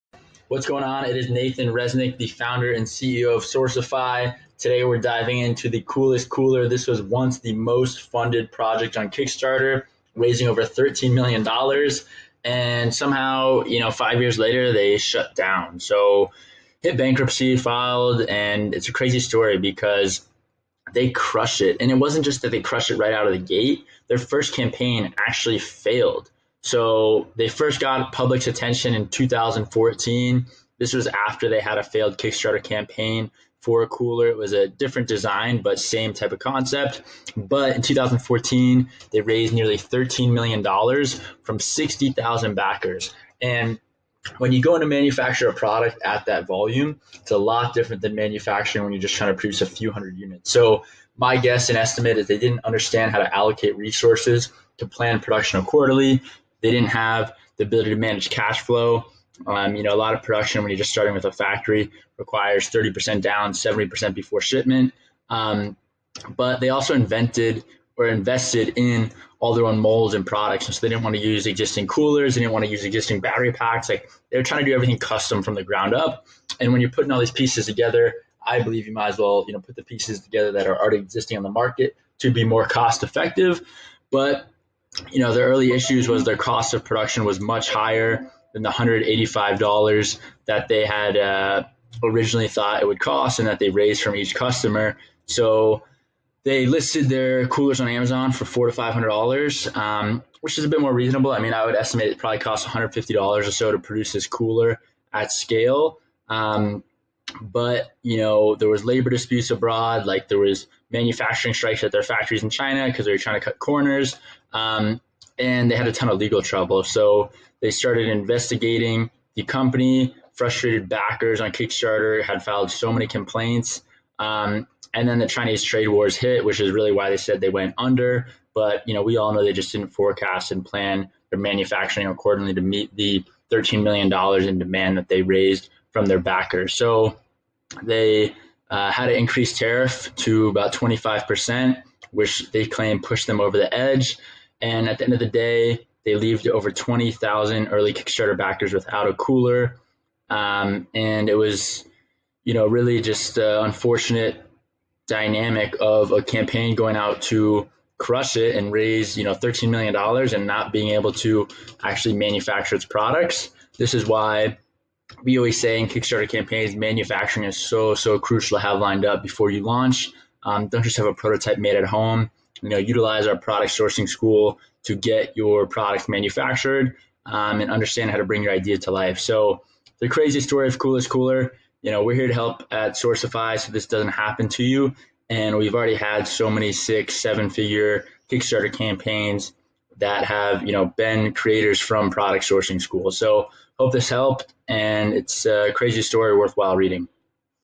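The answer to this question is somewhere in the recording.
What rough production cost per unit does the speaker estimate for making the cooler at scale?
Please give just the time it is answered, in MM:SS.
01:42.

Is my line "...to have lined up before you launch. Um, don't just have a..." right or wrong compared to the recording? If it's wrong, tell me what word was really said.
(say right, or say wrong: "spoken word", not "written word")
right.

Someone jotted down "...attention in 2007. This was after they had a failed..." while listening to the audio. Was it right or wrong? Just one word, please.
wrong.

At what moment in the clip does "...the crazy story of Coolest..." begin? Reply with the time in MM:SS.
02:59.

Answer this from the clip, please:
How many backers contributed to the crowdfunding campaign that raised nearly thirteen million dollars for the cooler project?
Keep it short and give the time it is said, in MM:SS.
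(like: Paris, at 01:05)
60,000, at 00:41.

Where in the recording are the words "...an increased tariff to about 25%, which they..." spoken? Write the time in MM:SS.
02:19.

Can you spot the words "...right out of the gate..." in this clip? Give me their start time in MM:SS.
00:22.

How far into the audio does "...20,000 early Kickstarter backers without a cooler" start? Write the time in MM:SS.
02:26.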